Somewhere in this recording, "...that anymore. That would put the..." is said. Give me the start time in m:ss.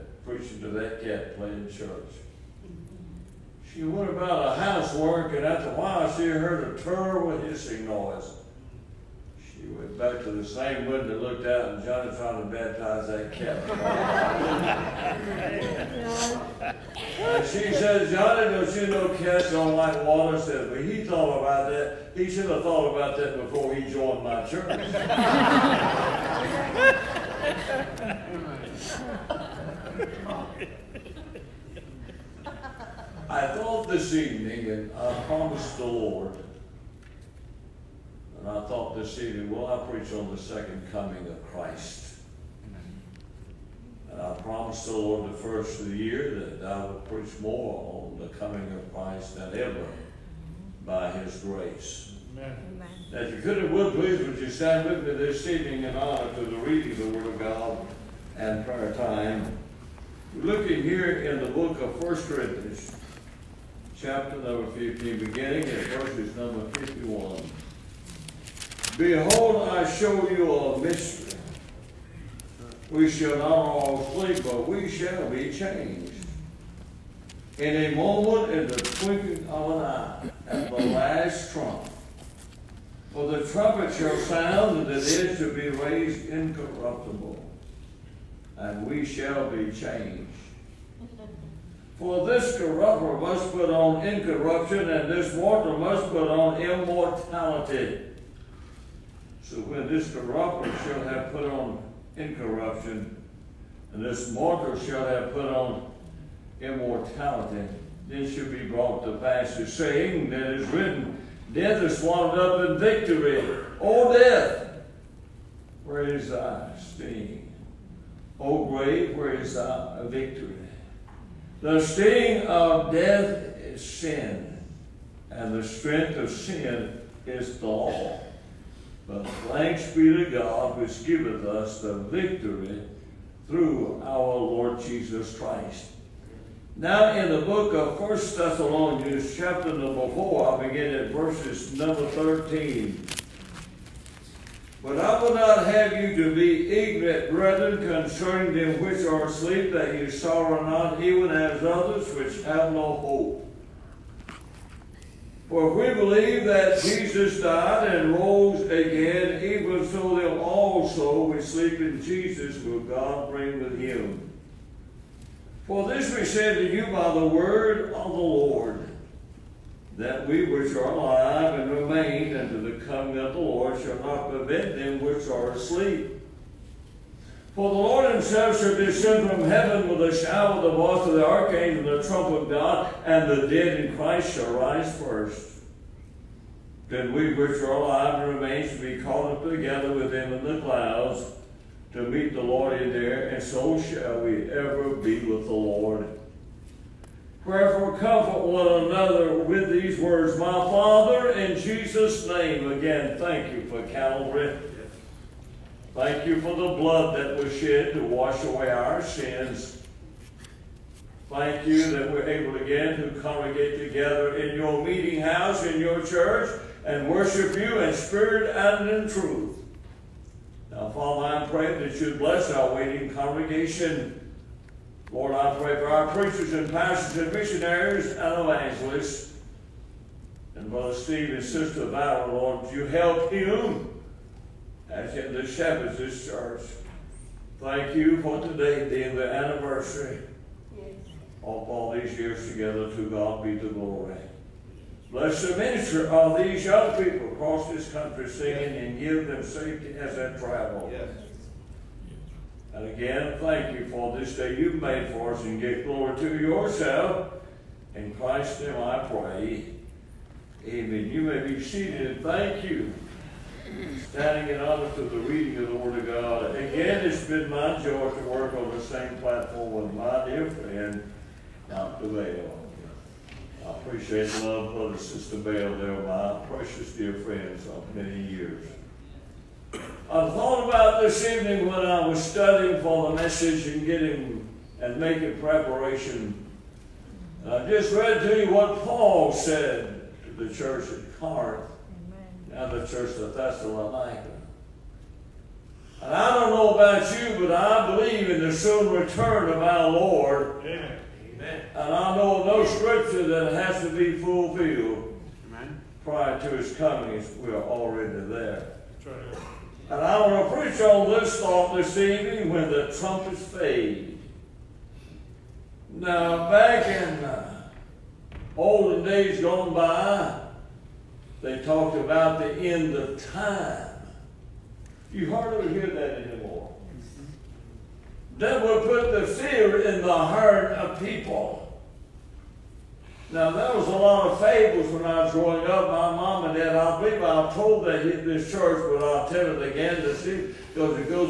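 5:25.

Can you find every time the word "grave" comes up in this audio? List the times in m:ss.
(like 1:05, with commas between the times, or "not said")
1:58.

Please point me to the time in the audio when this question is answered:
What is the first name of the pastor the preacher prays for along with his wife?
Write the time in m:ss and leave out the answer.
3:50.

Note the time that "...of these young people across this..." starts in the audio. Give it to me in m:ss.
4:06.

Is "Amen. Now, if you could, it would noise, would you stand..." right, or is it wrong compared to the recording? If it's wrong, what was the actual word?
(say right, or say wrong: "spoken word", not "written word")
wrong: "please", not "noise".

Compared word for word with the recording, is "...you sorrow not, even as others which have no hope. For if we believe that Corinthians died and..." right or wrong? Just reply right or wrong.
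wrong.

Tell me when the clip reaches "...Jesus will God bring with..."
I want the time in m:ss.
2:42.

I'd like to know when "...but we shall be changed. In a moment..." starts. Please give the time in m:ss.
1:14.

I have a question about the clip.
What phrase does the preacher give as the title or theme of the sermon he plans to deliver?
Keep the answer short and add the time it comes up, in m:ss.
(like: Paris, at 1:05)
When the trumpets fade, at 5:12.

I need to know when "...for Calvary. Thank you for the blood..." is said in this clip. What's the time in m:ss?
3:23.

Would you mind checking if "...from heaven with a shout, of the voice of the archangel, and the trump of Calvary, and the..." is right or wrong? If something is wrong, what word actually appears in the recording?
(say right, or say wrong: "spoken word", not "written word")
wrong: "God", not "Calvary".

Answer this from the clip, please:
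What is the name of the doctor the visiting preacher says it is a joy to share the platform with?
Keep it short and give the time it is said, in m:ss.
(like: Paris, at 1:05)
Dr. Bell, at 4:31.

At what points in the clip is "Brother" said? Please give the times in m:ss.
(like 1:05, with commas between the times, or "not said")
3:50, 4:34.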